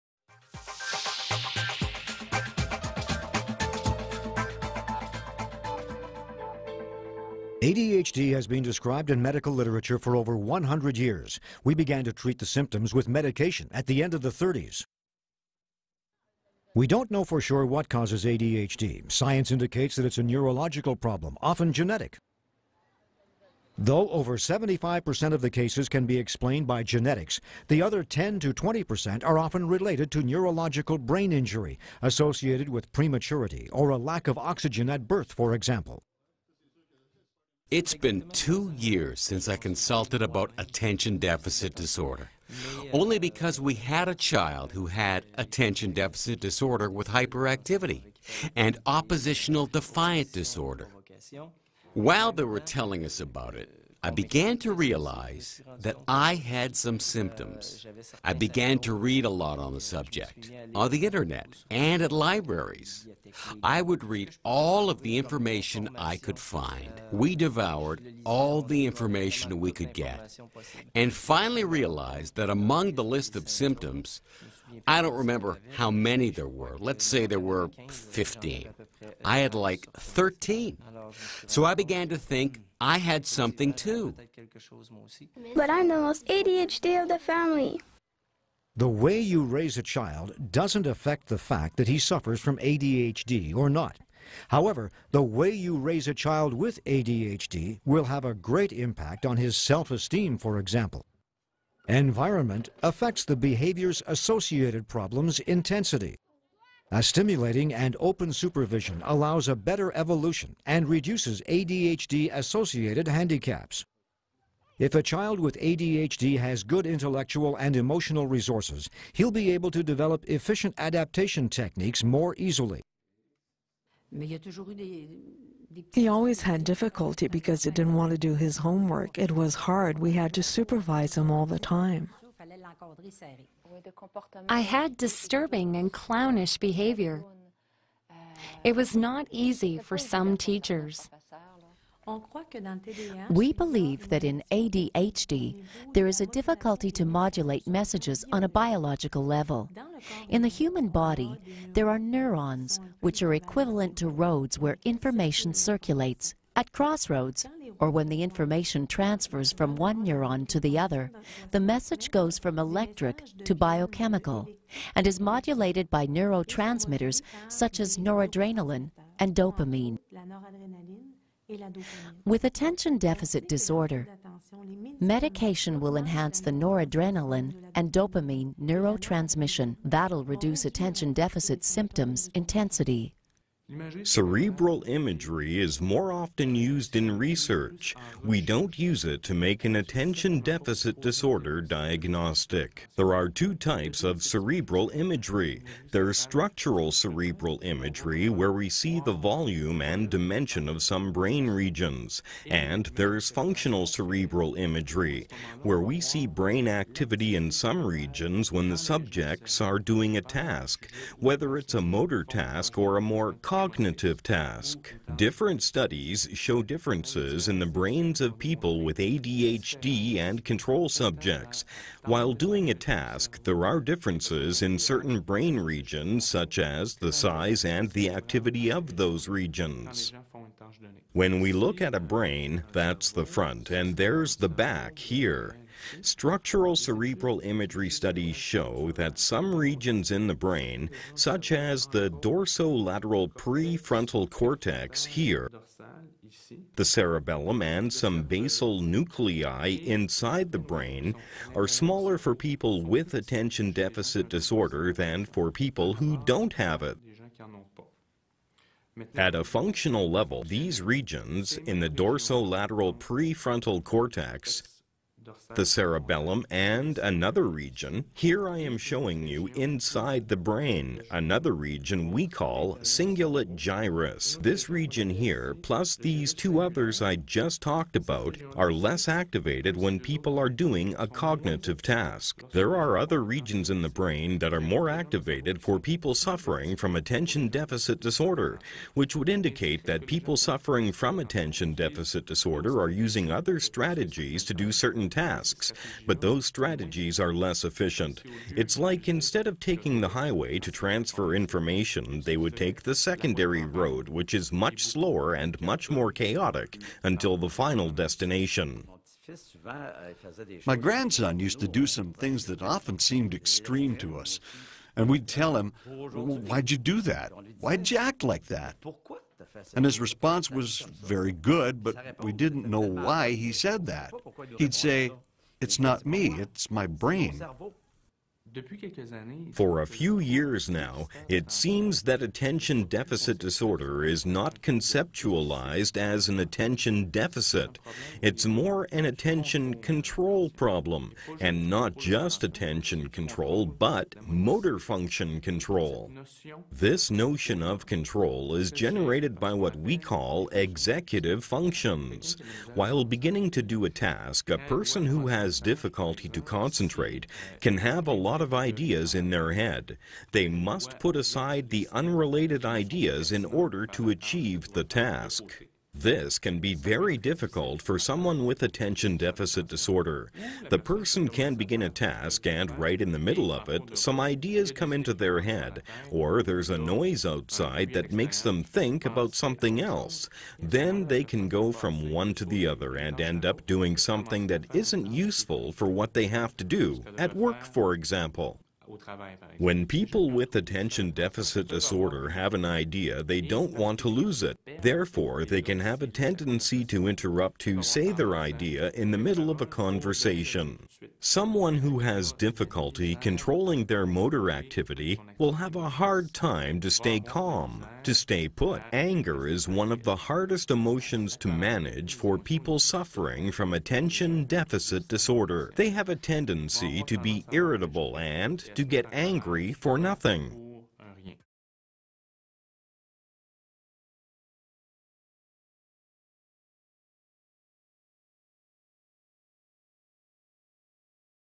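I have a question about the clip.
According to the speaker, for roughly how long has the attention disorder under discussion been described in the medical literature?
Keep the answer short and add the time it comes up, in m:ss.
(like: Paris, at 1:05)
over 100 years, at 0:10.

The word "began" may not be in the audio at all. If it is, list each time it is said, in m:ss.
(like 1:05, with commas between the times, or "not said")
0:11, 0:54, 0:58, 1:21.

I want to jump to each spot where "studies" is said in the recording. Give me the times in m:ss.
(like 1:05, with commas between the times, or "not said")
3:35, 3:57.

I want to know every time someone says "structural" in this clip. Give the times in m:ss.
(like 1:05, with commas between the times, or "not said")
3:16, 3:56.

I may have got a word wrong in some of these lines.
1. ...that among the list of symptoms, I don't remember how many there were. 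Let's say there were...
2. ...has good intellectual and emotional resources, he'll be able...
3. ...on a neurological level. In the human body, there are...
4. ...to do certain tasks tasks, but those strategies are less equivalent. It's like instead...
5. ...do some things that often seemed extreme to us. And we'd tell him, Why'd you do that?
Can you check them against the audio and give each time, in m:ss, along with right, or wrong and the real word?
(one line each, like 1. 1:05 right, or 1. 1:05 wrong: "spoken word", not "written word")
1. 1:12 right
2. 1:56 right
3. 2:28 wrong: "biological", not "neurological"
4. 4:54 wrong: "efficient", not "equivalent"
5. 5:11 right.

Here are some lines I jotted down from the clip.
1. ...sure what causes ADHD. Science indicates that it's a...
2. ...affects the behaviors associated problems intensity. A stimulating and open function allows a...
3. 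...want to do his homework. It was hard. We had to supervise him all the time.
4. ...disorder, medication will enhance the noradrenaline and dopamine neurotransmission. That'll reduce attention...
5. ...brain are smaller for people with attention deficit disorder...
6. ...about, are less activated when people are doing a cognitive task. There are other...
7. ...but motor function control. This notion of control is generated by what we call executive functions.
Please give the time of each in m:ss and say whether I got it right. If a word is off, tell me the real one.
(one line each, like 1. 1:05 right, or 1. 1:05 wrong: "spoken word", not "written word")
1. 0:17 right
2. 1:42 wrong: "supervision", not "function"
3. 2:07 right
4. 2:53 right
5. 4:10 right
6. 4:37 right
7. 5:43 right.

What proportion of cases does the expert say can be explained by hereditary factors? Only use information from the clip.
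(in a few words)
over 75%.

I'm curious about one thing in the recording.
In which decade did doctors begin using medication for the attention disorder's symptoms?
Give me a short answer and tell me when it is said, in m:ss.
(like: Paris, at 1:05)
the 30s, at 0:14.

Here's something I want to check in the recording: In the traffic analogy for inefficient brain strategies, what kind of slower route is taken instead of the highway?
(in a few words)
secondary road.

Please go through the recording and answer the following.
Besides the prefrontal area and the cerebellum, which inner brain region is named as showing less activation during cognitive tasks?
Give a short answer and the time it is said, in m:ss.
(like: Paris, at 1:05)
cingulate gyrus, at 4:32.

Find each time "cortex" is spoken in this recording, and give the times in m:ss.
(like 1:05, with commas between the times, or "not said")
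4:04, 4:23.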